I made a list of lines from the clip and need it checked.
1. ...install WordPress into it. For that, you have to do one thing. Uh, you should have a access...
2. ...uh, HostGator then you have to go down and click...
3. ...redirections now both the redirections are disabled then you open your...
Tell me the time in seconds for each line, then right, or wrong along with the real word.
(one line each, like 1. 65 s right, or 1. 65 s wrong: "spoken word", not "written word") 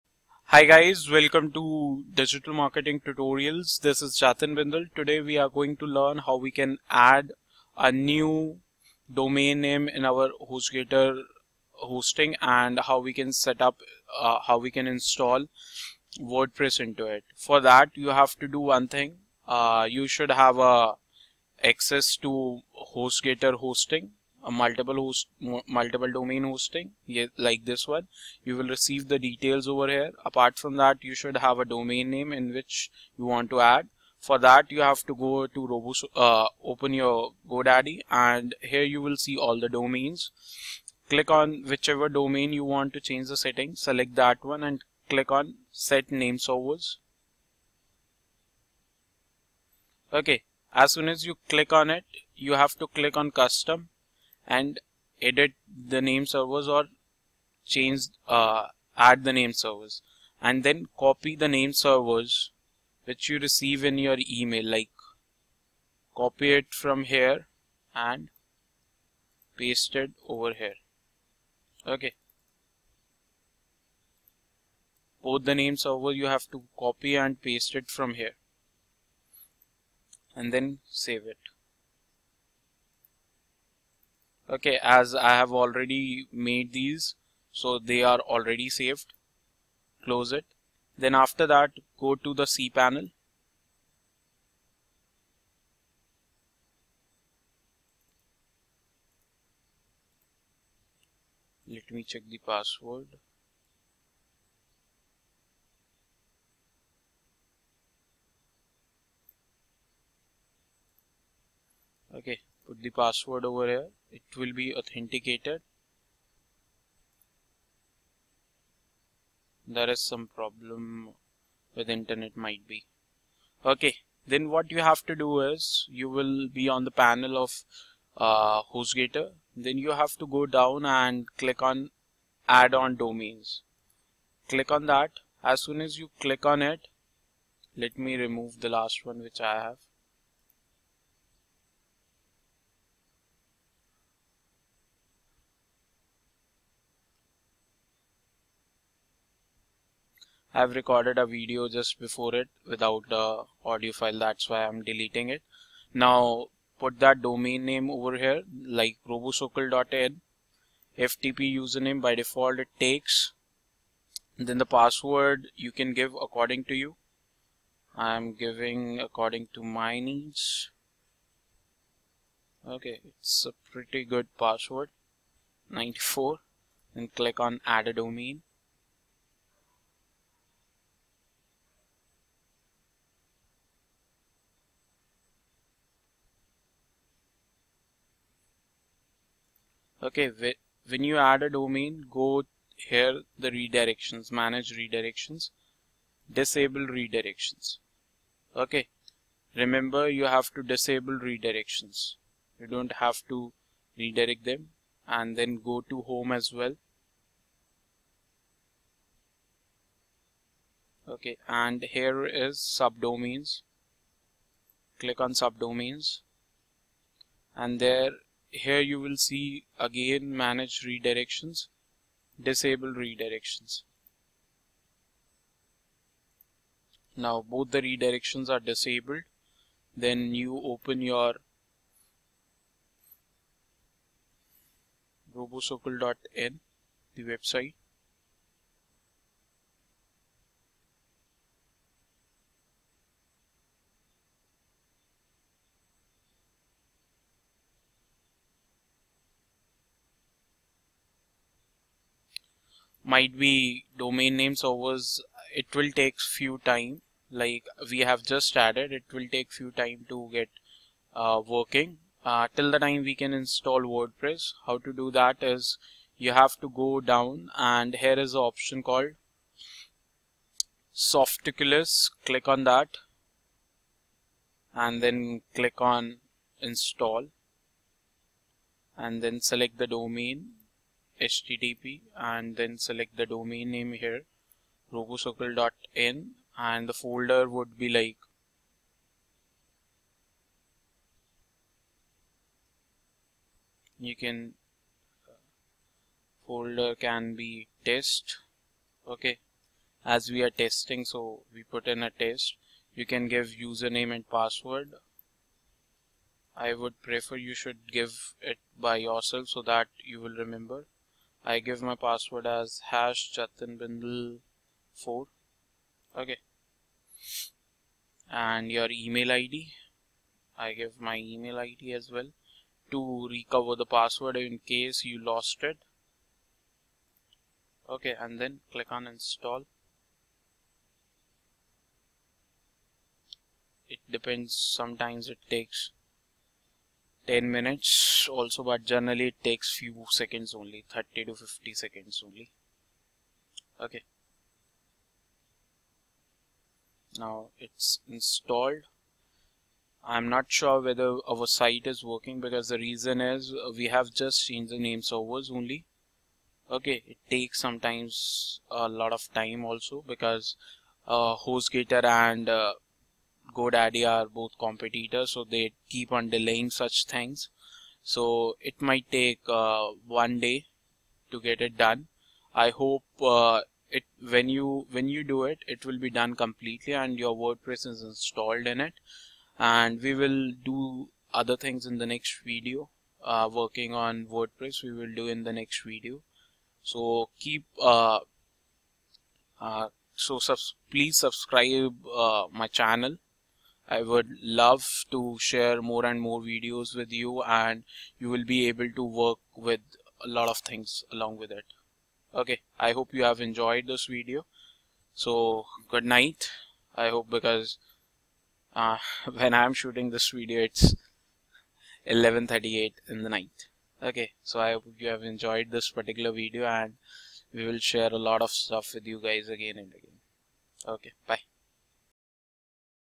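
1. 14 s right
2. 128 s right
3. 222 s right.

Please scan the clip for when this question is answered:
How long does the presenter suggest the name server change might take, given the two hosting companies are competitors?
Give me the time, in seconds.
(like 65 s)
370 s.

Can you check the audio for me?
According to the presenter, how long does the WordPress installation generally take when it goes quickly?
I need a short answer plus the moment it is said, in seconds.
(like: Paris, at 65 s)
30 to 50 seconds, at 340 s.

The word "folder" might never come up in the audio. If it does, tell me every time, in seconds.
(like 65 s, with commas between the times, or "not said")
286 s, 296 s.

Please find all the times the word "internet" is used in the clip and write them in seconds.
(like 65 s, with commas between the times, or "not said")
121 s.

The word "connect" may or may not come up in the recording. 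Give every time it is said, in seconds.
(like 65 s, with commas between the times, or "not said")
not said.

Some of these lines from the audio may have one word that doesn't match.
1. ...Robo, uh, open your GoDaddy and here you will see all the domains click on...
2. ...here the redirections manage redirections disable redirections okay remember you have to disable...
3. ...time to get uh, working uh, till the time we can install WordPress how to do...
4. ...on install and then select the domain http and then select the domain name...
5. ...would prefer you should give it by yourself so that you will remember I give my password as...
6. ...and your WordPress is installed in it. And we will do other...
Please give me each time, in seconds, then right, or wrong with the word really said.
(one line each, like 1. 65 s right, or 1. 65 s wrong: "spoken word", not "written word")
1. 35 s right
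2. 192 s right
3. 259 s right
4. 275 s right
5. 306 s right
6. 376 s right.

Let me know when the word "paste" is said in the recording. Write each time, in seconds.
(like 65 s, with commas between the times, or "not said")
69 s, 77 s.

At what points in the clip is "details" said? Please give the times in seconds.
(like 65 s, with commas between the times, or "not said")
29 s.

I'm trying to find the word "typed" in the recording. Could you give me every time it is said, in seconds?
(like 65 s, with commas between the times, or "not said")
not said.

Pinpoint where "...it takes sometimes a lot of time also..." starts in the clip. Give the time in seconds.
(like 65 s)
357 s.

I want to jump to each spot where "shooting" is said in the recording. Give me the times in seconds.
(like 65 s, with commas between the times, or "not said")
409 s.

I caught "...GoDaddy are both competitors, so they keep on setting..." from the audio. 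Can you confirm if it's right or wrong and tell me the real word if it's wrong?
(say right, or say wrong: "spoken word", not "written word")
wrong: "delaying", not "setting".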